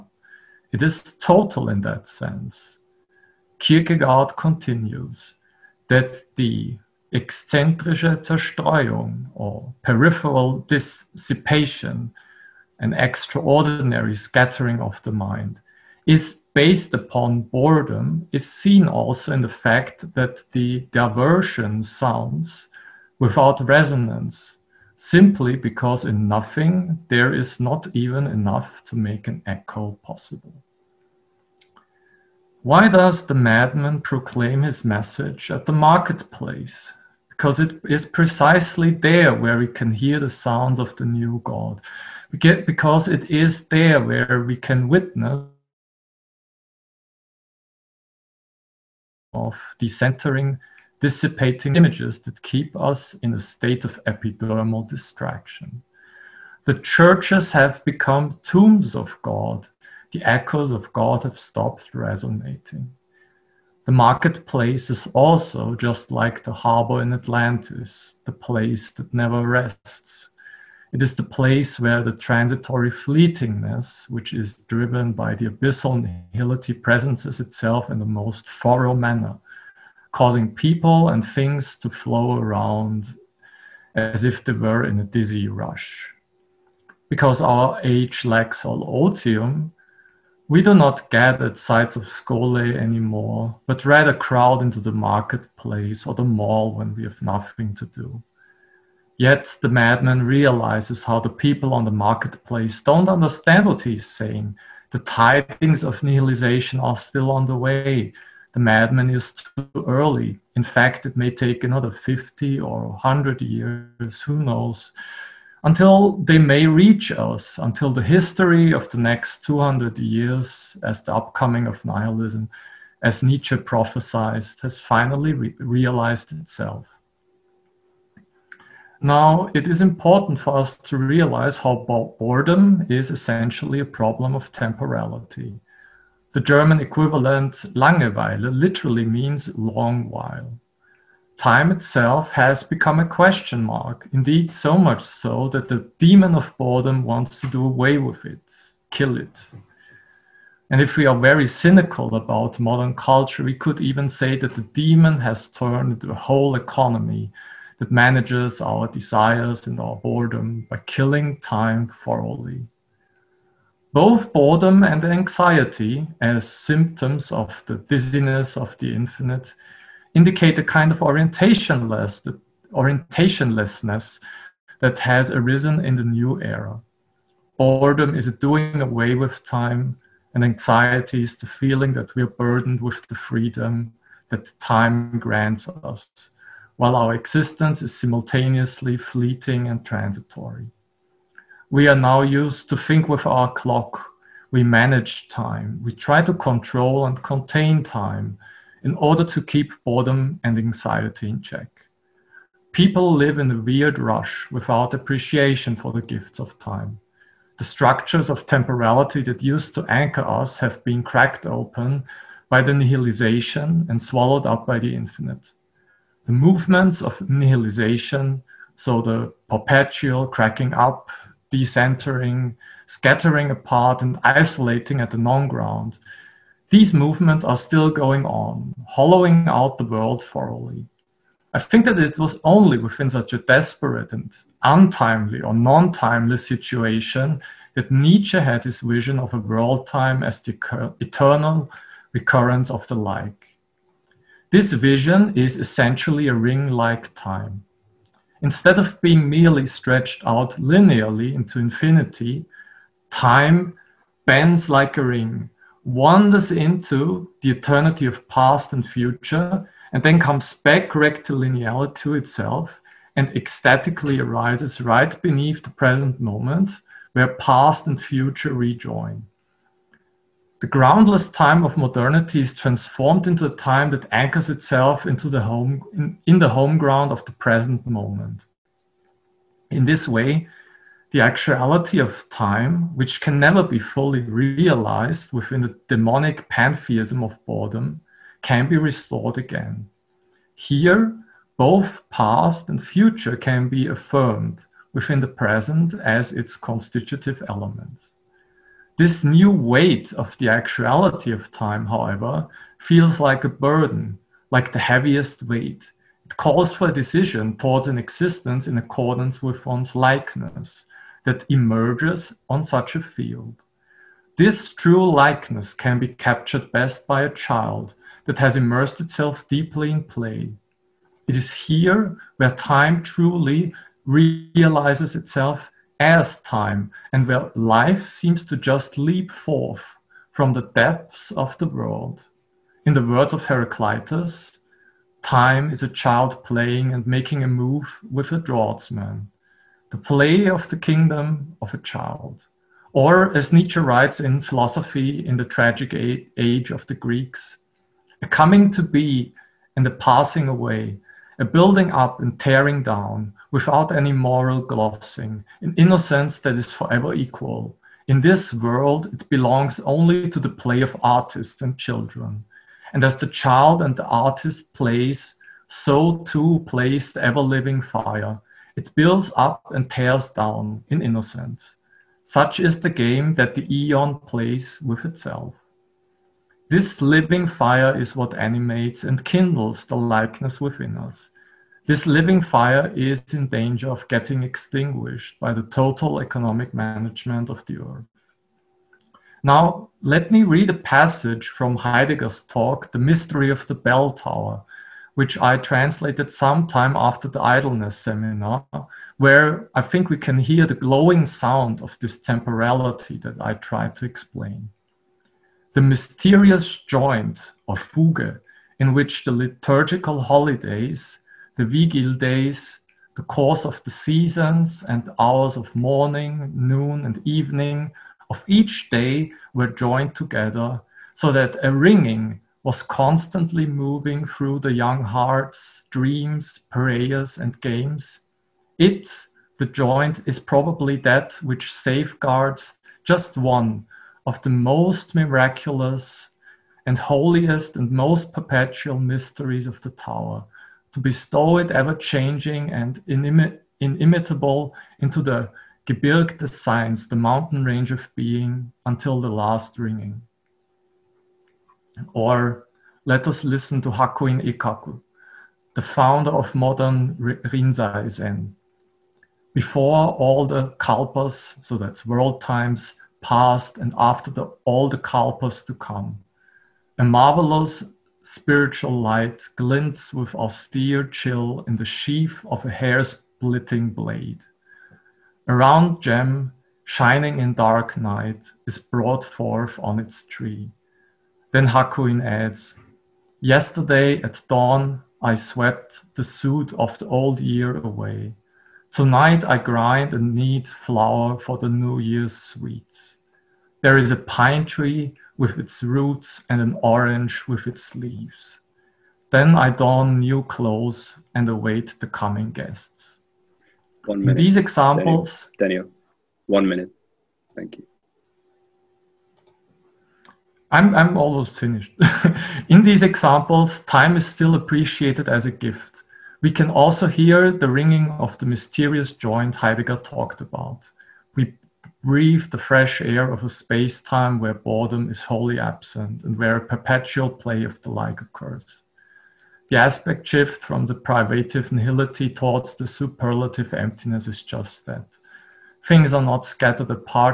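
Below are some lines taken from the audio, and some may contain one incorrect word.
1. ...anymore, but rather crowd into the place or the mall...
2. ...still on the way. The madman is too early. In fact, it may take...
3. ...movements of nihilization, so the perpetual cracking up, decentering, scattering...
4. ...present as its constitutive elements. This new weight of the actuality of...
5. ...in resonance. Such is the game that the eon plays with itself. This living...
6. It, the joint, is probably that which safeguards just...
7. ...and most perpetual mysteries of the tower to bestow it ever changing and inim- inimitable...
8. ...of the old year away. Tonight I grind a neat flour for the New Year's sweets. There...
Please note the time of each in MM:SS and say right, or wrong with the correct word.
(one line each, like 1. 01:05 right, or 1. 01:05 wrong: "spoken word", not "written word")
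1. 01:32 wrong: "marketplace", not "place"
2. 01:46 right
3. 03:36 right
4. 04:55 right
5. 06:10 wrong: "innocence", not "resonance"
6. 07:08 right
7. 07:17 right
8. 08:06 right.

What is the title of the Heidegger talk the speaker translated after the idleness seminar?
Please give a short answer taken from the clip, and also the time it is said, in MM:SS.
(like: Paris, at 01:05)
The Mystery of the Bell Tower, at 06:32.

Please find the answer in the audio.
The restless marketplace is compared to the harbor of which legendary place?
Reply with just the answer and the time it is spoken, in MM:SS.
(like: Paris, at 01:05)
Atlantis, at 01:07.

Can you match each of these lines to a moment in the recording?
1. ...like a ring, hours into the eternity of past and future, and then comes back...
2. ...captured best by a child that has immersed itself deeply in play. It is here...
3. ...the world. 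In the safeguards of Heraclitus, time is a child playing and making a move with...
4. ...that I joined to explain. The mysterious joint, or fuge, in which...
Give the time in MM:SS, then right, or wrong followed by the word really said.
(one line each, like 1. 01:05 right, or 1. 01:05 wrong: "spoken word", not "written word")
1. 04:14 wrong: "wanders", not "hours"
2. 05:16 right
3. 05:31 wrong: "words", not "safeguards"
4. 06:43 wrong: "tried", not "joined".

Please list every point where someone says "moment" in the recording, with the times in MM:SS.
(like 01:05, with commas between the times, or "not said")
04:26, 04:37.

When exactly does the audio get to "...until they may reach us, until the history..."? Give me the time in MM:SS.
01:55.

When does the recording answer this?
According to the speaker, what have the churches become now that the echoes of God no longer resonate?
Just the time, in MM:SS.
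00:58.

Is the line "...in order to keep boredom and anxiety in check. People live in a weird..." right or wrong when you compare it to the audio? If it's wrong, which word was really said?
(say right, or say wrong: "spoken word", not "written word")
right.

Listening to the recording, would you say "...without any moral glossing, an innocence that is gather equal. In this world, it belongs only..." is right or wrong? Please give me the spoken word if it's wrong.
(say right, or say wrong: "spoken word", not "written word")
wrong: "forever", not "gather".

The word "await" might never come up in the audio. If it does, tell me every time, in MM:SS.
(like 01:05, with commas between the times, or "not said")
08:21.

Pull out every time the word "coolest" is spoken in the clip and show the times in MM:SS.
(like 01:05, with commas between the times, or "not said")
not said.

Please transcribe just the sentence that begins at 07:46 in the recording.
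A marvelous spiritual light glints with austere chill in the sheath of a hair splitting blade.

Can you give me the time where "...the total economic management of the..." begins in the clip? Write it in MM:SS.
06:25.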